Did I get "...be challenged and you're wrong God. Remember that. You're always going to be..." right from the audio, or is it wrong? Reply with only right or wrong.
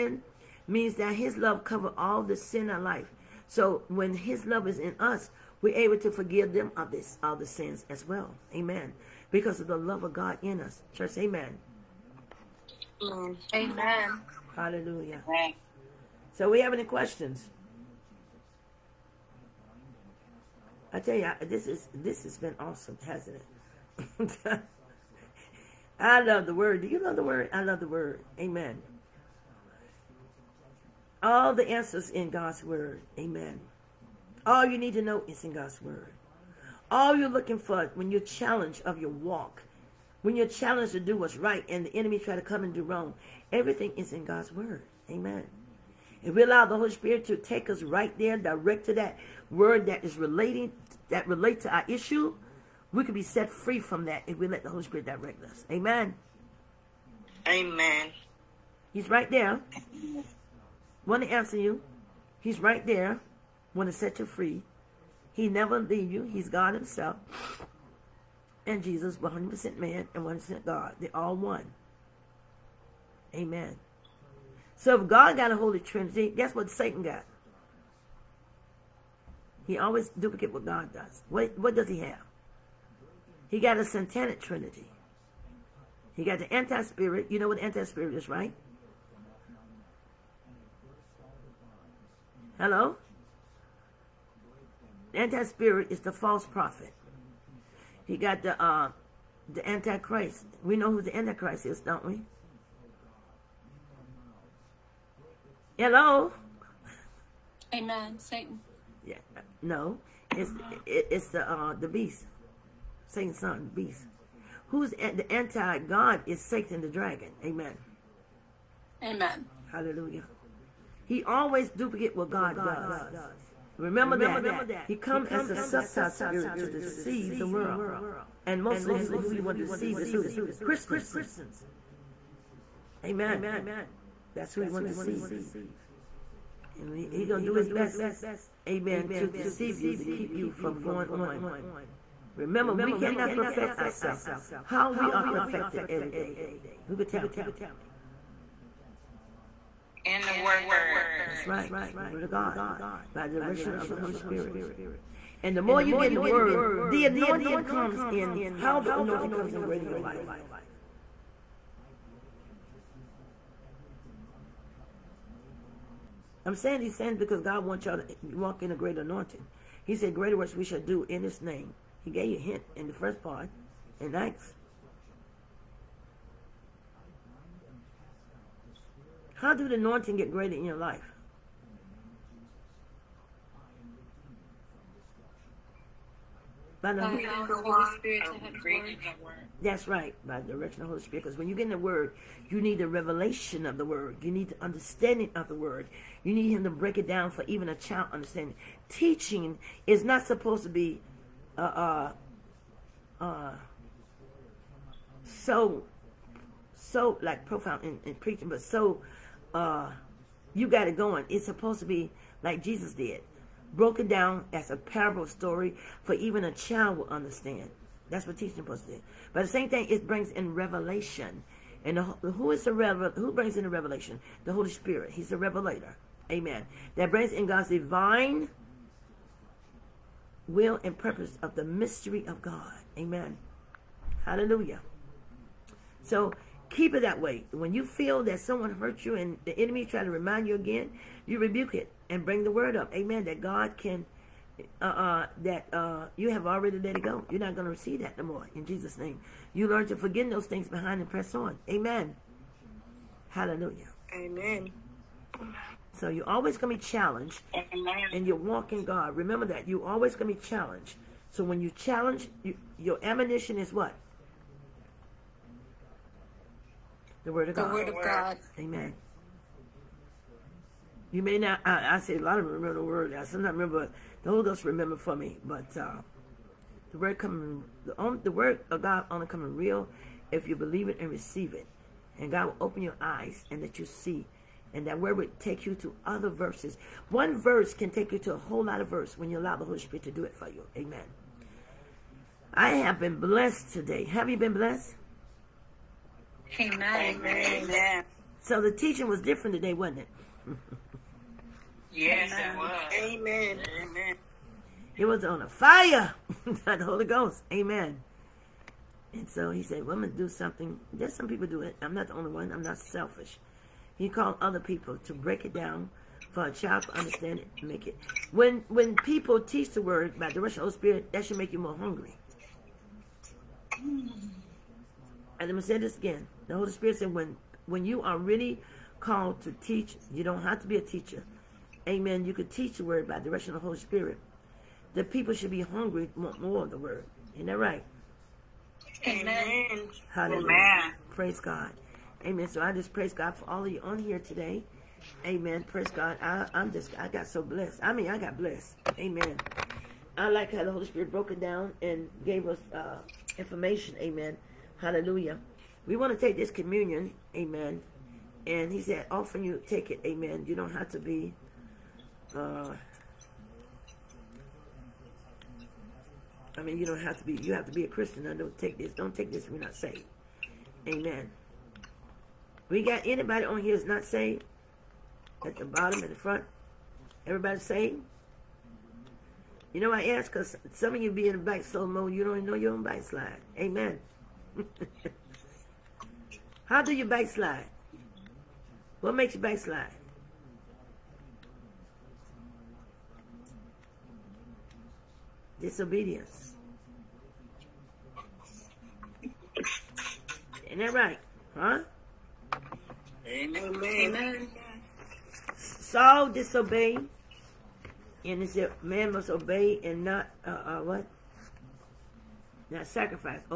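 wrong.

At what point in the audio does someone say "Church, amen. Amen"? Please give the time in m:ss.
0:10.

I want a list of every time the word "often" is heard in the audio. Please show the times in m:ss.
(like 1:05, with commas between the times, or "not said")
5:59.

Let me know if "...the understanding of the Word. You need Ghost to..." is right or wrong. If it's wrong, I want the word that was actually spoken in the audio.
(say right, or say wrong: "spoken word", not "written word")
wrong: "Him", not "Ghost".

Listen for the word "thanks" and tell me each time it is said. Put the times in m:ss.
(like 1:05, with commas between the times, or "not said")
2:54.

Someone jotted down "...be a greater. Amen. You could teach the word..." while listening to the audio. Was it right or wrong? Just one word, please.
wrong.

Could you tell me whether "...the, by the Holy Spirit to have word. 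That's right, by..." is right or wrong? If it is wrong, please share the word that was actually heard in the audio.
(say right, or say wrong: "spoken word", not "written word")
right.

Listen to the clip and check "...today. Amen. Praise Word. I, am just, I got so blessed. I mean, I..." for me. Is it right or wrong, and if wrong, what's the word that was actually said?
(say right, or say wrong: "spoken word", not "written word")
wrong: "God", not "Word".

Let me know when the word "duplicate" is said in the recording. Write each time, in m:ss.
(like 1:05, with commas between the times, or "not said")
1:20, 2:01.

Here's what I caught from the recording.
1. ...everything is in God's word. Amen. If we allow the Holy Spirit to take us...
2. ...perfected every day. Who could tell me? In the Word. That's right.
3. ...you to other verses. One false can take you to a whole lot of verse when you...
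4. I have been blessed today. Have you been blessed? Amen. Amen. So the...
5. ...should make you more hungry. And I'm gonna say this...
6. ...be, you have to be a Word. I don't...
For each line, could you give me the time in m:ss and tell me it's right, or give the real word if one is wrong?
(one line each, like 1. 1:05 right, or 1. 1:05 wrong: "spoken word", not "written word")
1. 0:43 right
2. 2:25 right
3. 4:45 wrong: "verse", not "false"
4. 4:52 right
5. 5:21 right
6. 6:07 wrong: "Christian", not "Word".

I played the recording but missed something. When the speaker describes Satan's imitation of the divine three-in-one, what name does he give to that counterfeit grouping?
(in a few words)
satanic trinity.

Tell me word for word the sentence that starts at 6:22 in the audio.
You don't even know your own backslide.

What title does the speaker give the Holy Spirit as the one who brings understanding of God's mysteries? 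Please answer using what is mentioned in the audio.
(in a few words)
the revelator.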